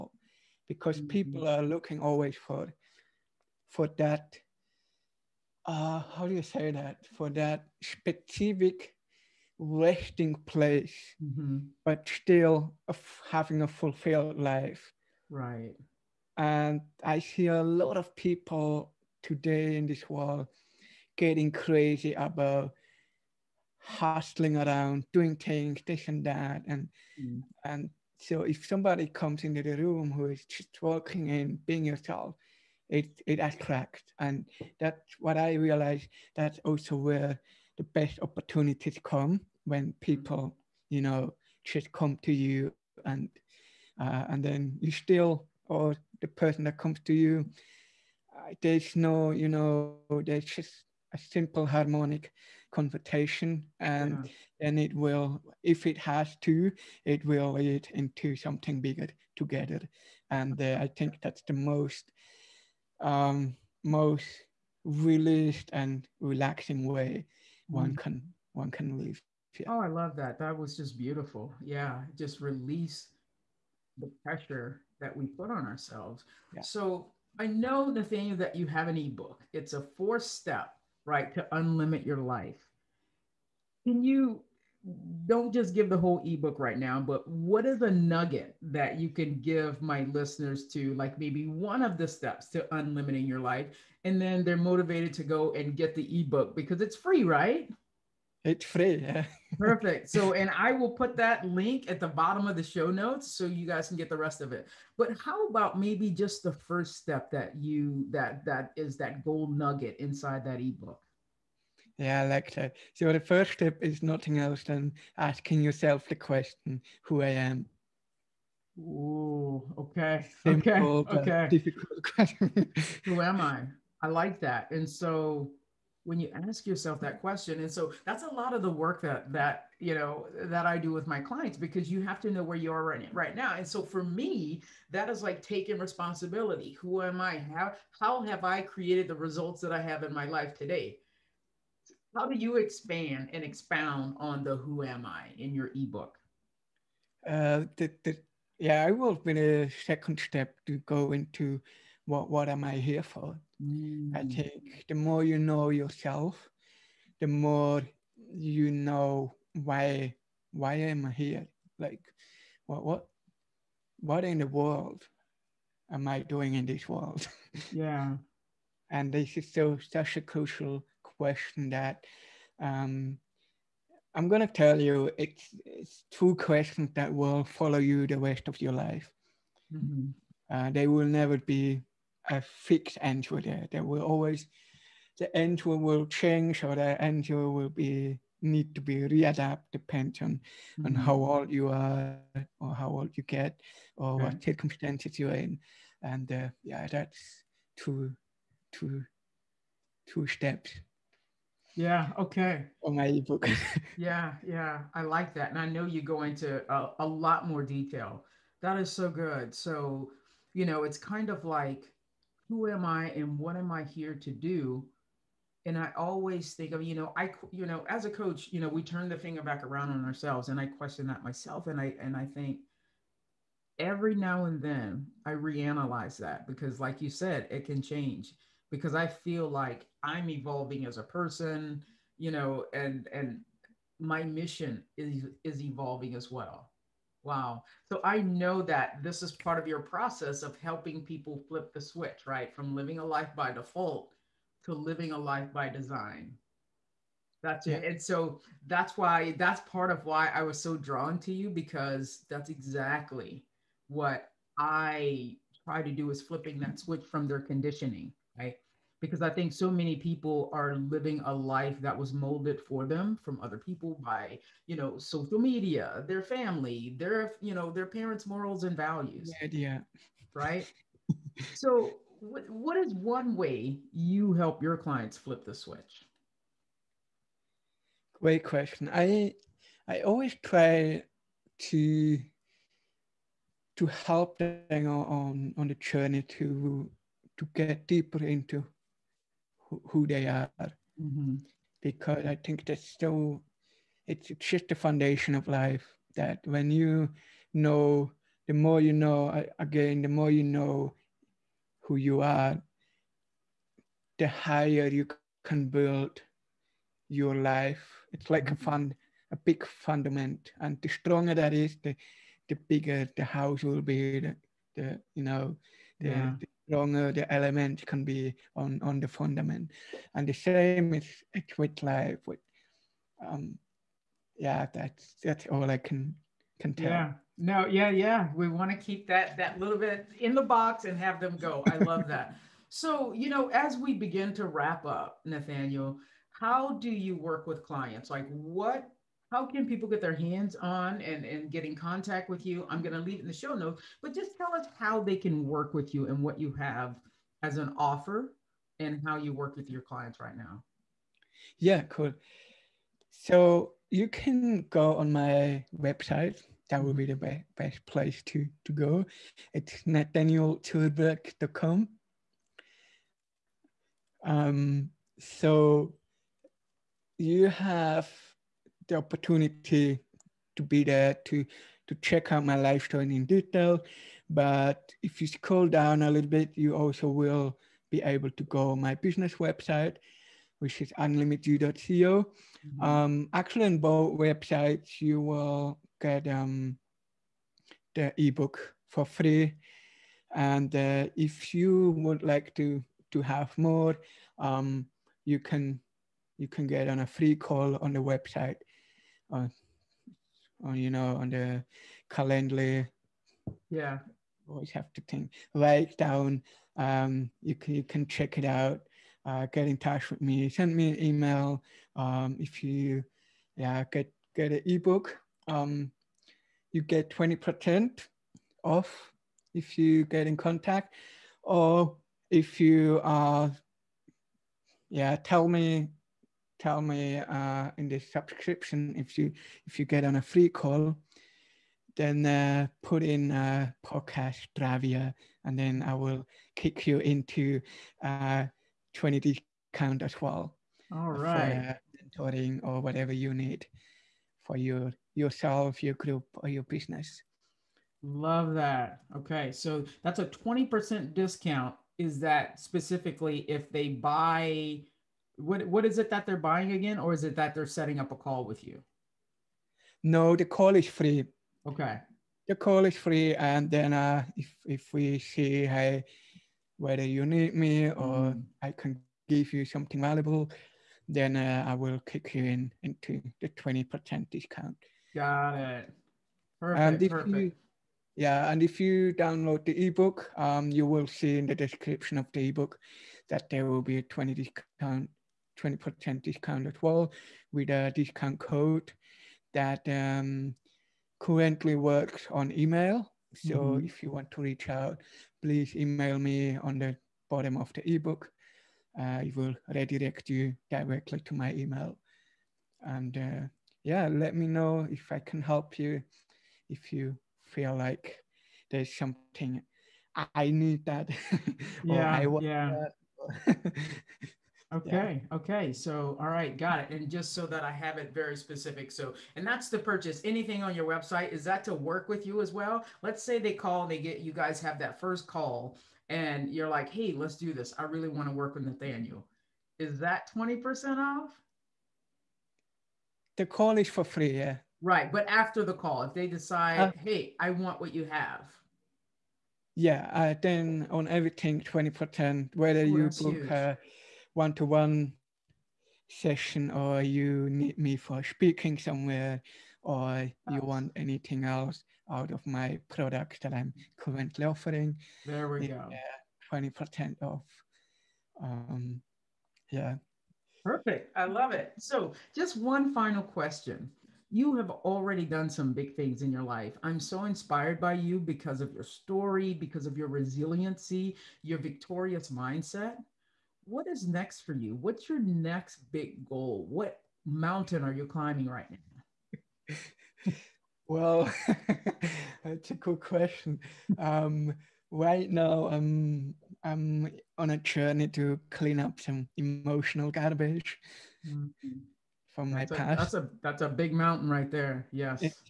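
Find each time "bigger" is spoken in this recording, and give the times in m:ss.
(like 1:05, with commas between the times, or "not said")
0:58, 5:12.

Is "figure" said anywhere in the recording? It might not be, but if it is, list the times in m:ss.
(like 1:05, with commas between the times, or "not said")
not said.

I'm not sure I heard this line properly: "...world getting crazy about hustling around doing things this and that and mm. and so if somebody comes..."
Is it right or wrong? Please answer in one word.
right.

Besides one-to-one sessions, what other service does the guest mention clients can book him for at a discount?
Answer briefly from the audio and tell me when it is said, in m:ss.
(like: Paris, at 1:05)
Speaking, at 9:08.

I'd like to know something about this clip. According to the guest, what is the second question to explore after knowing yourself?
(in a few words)
What am I here for.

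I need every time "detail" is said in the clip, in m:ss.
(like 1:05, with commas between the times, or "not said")
3:27, 6:13.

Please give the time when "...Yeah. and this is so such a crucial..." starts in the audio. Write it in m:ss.
2:47.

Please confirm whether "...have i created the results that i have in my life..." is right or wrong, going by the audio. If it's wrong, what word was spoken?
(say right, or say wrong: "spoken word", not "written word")
right.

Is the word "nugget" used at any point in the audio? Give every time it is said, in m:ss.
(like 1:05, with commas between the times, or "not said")
1:27, 1:49.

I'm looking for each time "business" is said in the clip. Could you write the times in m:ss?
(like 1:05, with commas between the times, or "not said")
6:18, 7:26.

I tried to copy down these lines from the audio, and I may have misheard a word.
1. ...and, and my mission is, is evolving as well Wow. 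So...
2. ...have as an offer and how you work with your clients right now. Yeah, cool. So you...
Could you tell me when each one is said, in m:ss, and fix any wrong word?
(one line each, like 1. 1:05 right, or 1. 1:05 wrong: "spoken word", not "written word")
1. 3:52 right
2. 5:46 right.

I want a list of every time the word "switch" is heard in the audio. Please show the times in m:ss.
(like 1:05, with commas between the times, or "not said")
4:01, 4:16, 4:35.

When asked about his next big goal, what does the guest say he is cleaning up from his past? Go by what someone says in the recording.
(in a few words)
Emotional garbage.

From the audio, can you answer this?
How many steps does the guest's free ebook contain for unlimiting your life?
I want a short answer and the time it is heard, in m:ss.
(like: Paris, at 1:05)
4, at 1:19.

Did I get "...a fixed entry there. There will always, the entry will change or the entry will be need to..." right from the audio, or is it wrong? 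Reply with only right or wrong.
right.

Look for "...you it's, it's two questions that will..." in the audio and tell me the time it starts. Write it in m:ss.
2:54.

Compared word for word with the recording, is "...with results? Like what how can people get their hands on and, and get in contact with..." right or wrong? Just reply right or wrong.
wrong.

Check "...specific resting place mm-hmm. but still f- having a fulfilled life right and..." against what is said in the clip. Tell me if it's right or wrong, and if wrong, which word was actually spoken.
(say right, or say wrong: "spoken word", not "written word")
right.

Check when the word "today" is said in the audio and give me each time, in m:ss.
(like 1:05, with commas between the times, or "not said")
0:19, 2:20.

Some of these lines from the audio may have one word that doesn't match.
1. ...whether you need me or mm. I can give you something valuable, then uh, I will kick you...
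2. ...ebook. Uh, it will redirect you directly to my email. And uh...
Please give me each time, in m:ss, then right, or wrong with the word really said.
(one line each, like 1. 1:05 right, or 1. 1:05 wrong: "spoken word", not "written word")
1. 7:46 right
2. 8:17 right.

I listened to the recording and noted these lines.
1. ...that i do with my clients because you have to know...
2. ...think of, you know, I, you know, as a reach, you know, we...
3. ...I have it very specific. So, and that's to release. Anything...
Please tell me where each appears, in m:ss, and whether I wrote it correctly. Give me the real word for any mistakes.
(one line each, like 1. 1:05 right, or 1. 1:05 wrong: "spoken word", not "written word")
1. 2:10 right
2. 3:36 wrong: "coach", not "reach"
3. 8:37 wrong: "purchase", not "release".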